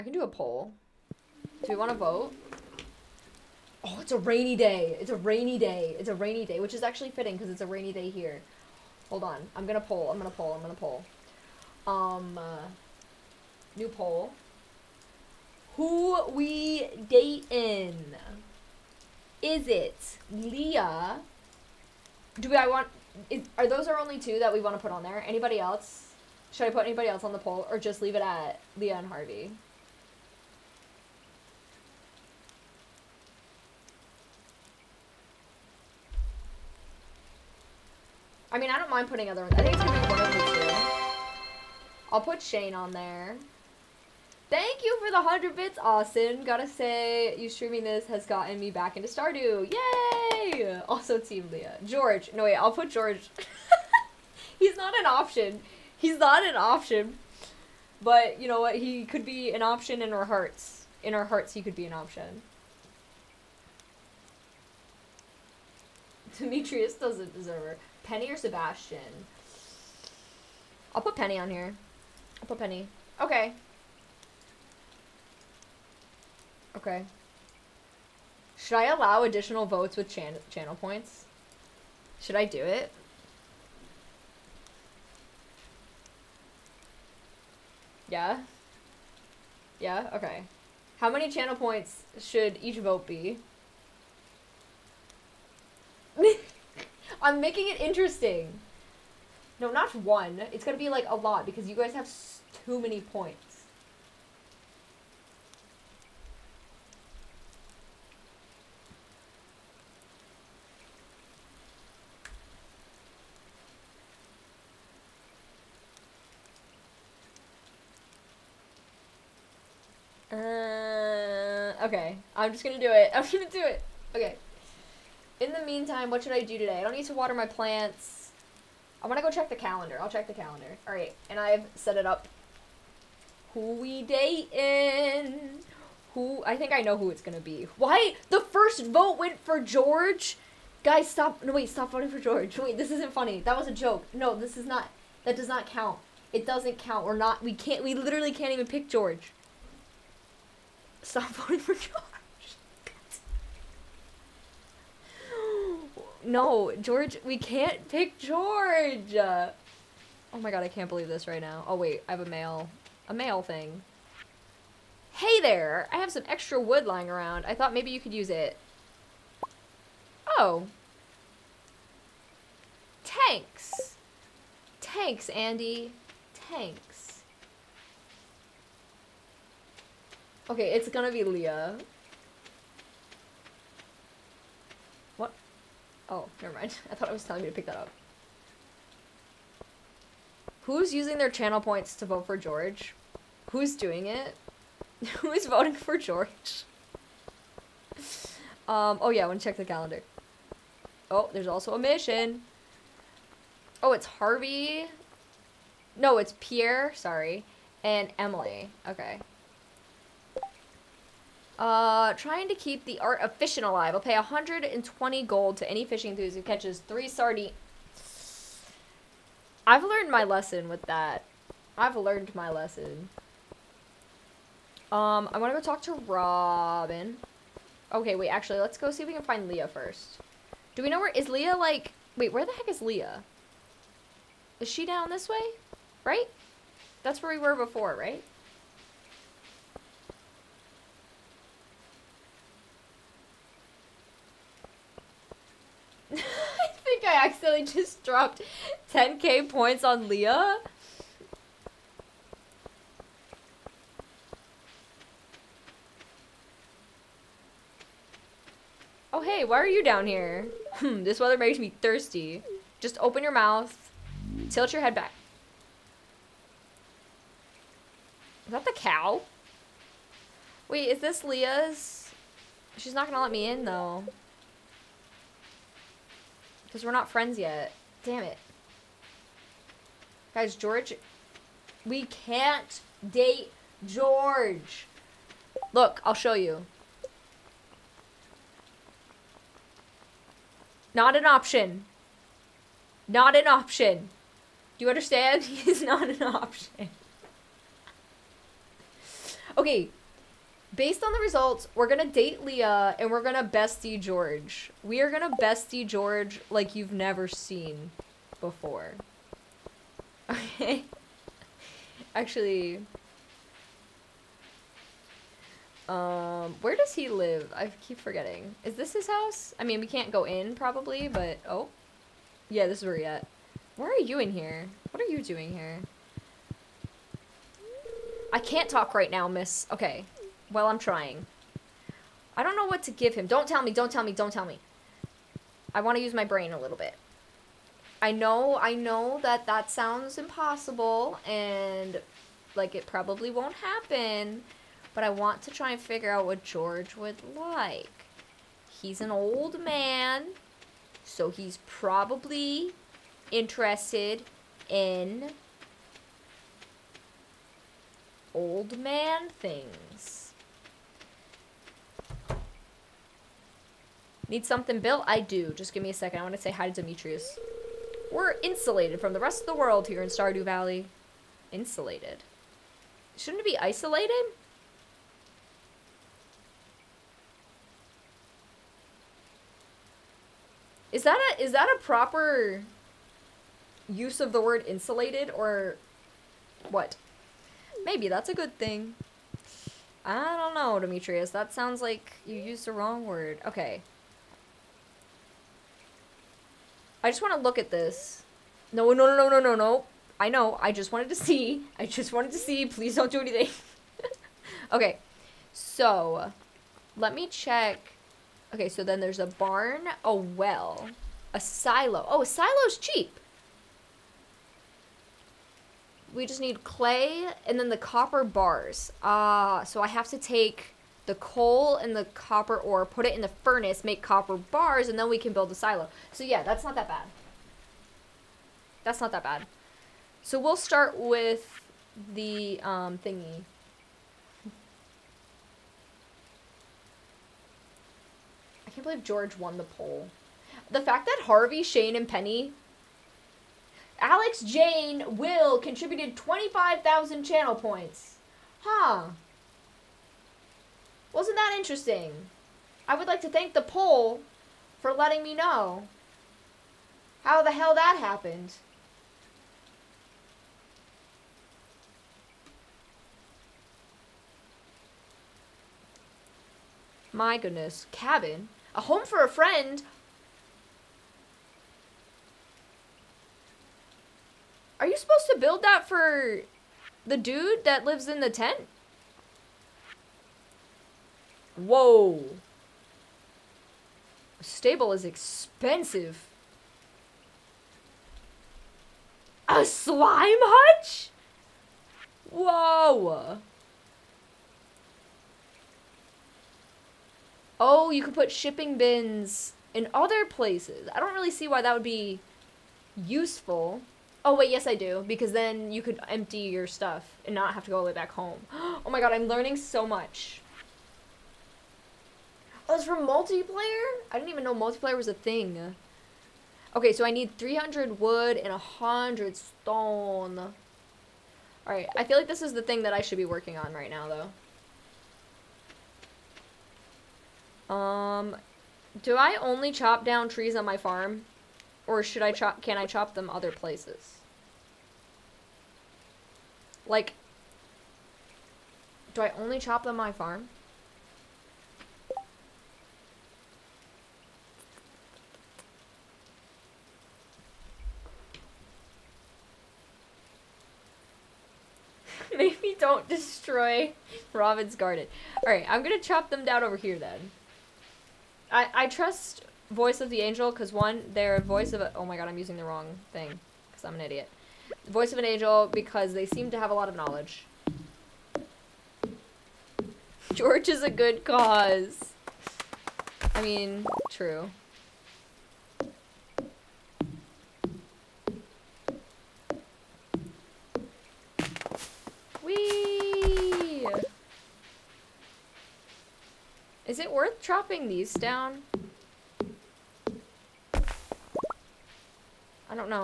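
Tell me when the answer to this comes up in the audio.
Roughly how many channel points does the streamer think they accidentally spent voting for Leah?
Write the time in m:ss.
4:08.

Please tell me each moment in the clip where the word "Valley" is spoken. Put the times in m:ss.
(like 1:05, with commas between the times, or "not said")
6:10.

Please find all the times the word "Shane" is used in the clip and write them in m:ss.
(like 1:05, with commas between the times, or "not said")
0:42, 7:21.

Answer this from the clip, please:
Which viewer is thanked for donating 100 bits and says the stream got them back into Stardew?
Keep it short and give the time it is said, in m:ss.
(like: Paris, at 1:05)
Austin, at 0:45.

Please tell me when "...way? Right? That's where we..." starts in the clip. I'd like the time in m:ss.
3:55.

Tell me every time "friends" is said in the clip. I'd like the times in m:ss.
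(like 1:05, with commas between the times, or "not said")
4:37, 7:49.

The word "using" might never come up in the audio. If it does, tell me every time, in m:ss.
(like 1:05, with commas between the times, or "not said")
3:10, 9:22.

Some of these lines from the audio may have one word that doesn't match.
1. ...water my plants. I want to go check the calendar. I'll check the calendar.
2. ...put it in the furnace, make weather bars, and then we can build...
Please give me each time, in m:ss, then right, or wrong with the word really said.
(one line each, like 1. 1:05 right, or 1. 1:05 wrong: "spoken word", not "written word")
1. 2:07 right
2. 7:02 wrong: "copper", not "weather".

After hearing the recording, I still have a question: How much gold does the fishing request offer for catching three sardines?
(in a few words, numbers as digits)
120.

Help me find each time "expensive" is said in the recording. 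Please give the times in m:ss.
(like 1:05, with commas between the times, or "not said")
8:05.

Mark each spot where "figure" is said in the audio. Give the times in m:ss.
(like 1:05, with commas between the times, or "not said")
5:45.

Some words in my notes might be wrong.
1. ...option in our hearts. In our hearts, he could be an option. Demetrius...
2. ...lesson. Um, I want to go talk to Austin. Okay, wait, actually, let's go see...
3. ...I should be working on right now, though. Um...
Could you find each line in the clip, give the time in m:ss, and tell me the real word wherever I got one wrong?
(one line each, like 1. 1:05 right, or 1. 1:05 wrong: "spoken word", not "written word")
1. 0:59 right
2. 3:42 wrong: "Robin", not "Austin"
3. 8:42 right.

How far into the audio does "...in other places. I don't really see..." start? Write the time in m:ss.
8:19.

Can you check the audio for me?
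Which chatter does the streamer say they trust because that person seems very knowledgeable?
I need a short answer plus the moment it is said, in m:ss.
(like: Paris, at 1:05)
Voice of the Angel, at 9:19.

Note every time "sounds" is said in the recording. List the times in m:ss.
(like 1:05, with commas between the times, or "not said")
5:39, 6:31.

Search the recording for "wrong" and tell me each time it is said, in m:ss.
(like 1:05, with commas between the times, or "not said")
6:32, 9:22.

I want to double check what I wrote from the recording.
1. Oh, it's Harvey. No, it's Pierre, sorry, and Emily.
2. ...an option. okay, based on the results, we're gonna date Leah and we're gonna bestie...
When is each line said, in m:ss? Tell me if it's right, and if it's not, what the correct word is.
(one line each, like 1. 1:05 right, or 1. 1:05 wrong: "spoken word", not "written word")
1. 3:23 right
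2. 4:56 right.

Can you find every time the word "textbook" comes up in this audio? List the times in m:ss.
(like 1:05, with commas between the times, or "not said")
not said.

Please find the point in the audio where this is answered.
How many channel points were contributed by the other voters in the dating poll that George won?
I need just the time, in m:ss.
7:26.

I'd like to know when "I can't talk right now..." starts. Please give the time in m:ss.
5:28.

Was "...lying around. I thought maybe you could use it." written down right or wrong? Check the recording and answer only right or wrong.
right.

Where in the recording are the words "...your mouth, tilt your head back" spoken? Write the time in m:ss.
4:23.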